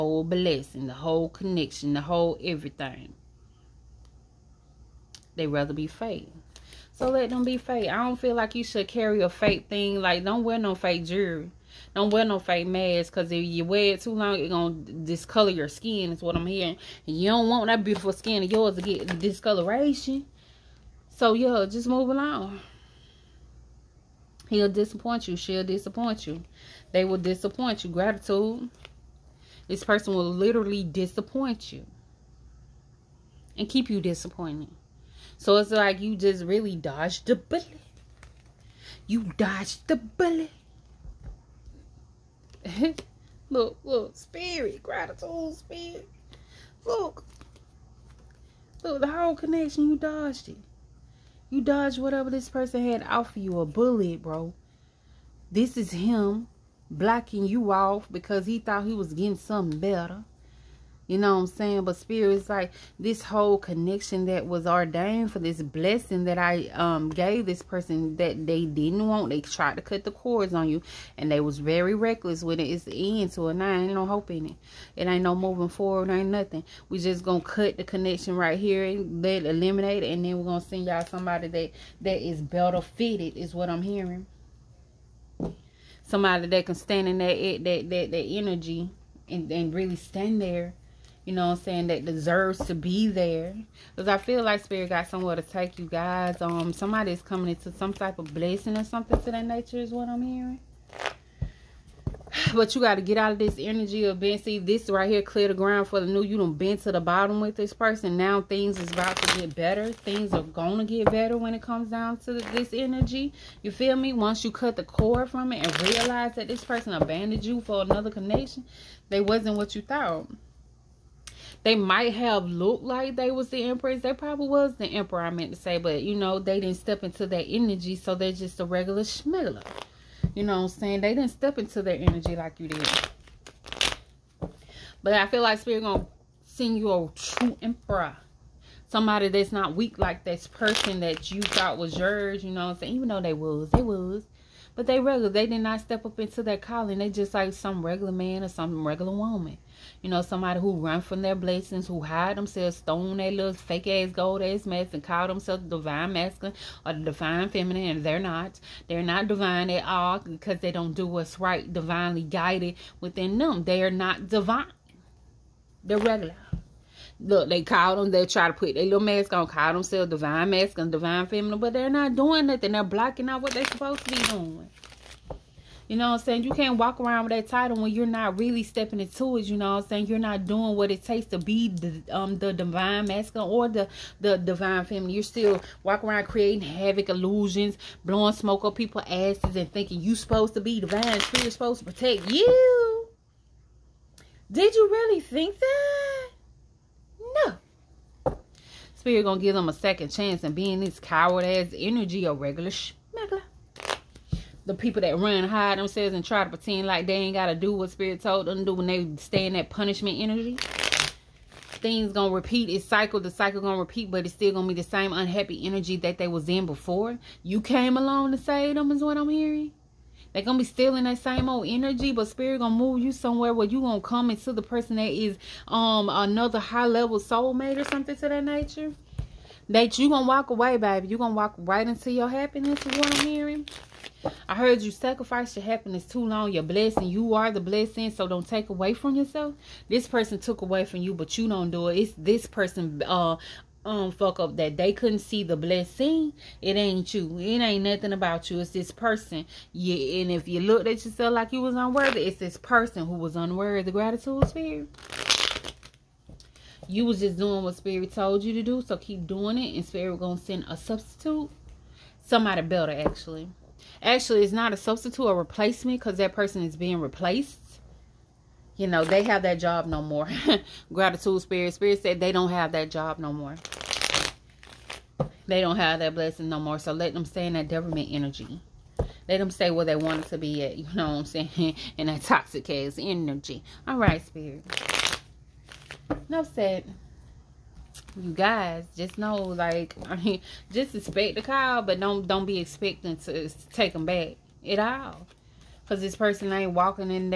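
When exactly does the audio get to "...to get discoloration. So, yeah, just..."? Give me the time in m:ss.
0:18.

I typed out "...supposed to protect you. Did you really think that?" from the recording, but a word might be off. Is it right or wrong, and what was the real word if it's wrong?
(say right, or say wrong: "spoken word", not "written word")
right.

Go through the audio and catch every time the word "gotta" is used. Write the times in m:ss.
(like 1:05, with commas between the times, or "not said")
3:27.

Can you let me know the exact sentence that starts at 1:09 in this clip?
They tried to cut the cords on you and they was very reckless with it.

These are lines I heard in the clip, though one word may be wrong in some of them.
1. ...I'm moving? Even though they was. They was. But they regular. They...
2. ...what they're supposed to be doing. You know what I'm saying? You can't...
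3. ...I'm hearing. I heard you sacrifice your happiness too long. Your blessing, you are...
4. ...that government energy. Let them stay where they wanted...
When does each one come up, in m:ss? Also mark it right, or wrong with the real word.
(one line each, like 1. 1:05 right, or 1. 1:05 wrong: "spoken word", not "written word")
1. 2:22 wrong: "saying", not "moving"
2. 2:53 right
3. 3:53 right
4. 4:37 right.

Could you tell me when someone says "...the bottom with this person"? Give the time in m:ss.
1:46.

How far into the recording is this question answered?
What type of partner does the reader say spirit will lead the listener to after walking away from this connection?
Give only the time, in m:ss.
3:46.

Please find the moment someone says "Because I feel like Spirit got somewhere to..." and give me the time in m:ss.
1:33.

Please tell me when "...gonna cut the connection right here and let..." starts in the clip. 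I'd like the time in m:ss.
1:17.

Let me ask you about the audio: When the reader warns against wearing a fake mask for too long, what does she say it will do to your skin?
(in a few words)
discolor your skin.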